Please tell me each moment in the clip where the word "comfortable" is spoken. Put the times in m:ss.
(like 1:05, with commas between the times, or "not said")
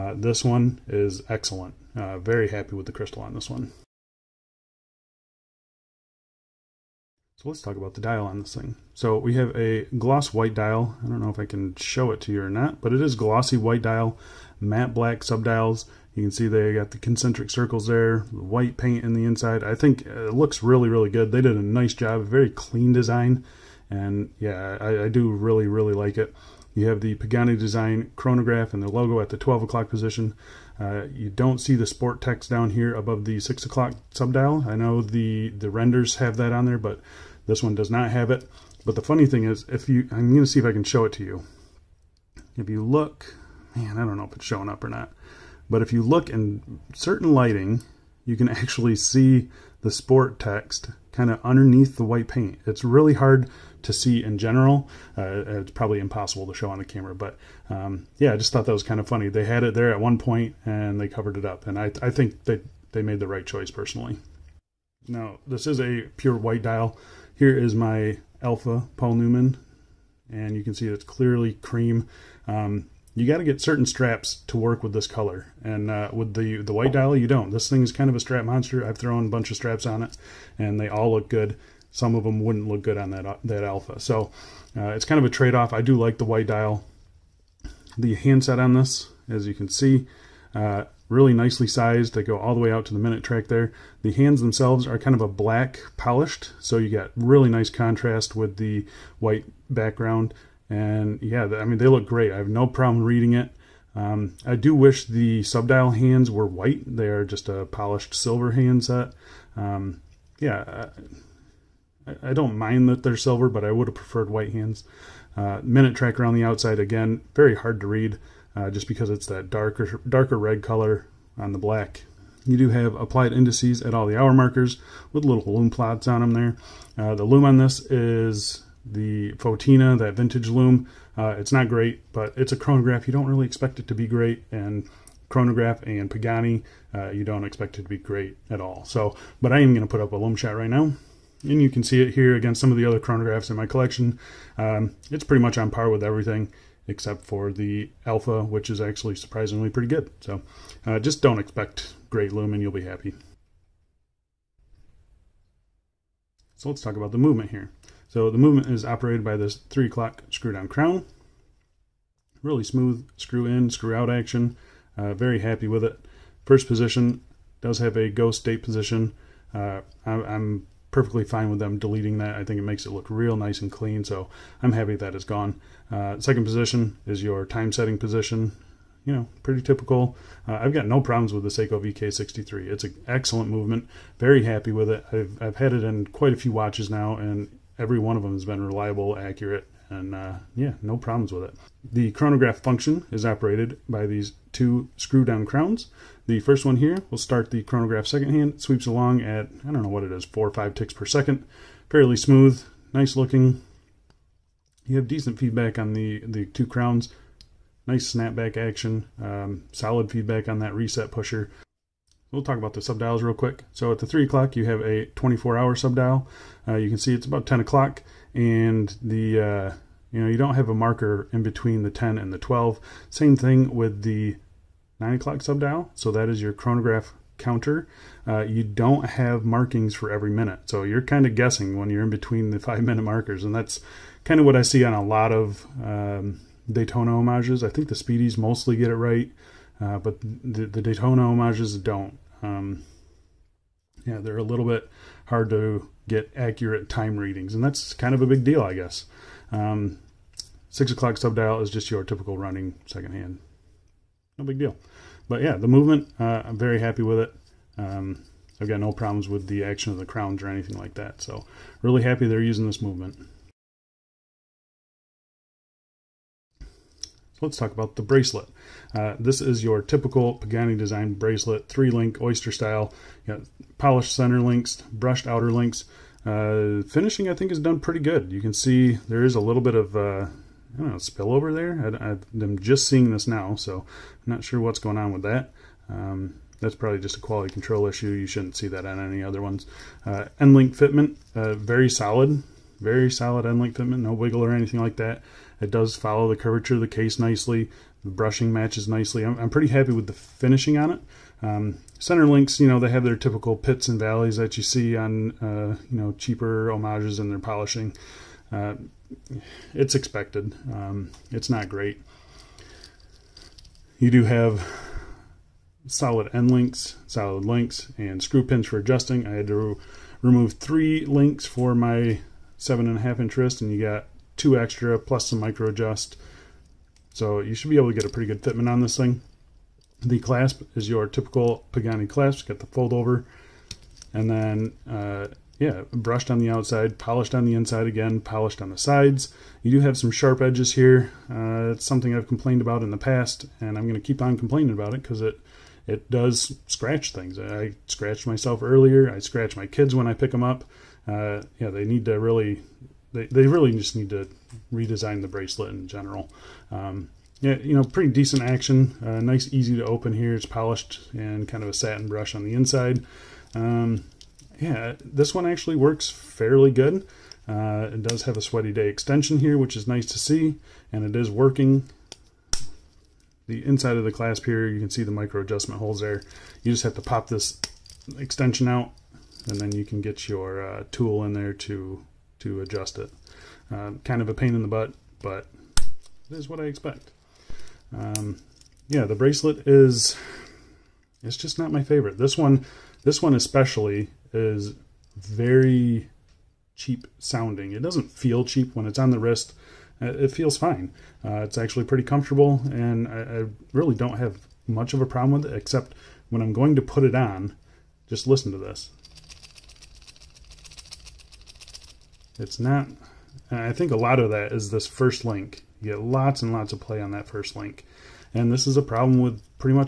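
6:42.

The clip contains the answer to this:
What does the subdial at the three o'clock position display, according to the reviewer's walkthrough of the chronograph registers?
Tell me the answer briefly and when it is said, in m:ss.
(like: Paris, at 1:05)
24-hour, at 3:35.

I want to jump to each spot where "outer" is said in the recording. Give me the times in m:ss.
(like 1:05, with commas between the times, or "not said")
4:35.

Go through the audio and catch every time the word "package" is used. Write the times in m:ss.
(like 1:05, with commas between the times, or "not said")
not said.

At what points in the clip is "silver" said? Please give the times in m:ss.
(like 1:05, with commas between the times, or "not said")
1:48, 1:53.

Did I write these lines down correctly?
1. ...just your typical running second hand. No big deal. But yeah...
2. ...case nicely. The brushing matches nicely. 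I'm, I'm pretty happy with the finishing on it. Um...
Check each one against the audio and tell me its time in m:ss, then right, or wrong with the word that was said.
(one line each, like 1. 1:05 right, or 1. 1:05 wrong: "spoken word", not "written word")
1. 4:11 right
2. 4:56 right.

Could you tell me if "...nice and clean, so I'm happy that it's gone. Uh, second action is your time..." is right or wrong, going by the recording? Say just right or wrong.
wrong.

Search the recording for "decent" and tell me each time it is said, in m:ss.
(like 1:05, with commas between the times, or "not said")
3:25, 5:58.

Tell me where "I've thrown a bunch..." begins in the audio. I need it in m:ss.
1:18.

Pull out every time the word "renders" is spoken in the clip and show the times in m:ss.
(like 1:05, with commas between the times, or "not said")
0:35.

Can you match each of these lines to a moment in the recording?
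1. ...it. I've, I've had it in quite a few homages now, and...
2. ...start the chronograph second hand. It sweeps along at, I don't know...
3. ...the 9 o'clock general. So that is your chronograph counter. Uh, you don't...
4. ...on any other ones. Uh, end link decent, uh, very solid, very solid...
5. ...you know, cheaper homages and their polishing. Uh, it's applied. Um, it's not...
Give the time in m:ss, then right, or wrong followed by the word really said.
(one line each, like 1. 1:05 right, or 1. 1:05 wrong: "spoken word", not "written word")
1. 3:04 wrong: "watches", not "homages"
2. 3:17 right
3. 3:44 wrong: "subdial", not "general"
4. 4:48 wrong: "fitment", not "decent"
5. 5:05 wrong: "expected", not "applied".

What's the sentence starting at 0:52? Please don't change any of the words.
It's really hard to see in general.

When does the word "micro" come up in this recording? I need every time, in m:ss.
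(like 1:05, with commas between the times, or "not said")
5:25, 6:15.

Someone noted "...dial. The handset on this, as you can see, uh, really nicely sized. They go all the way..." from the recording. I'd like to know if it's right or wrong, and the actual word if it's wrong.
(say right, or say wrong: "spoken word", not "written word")
right.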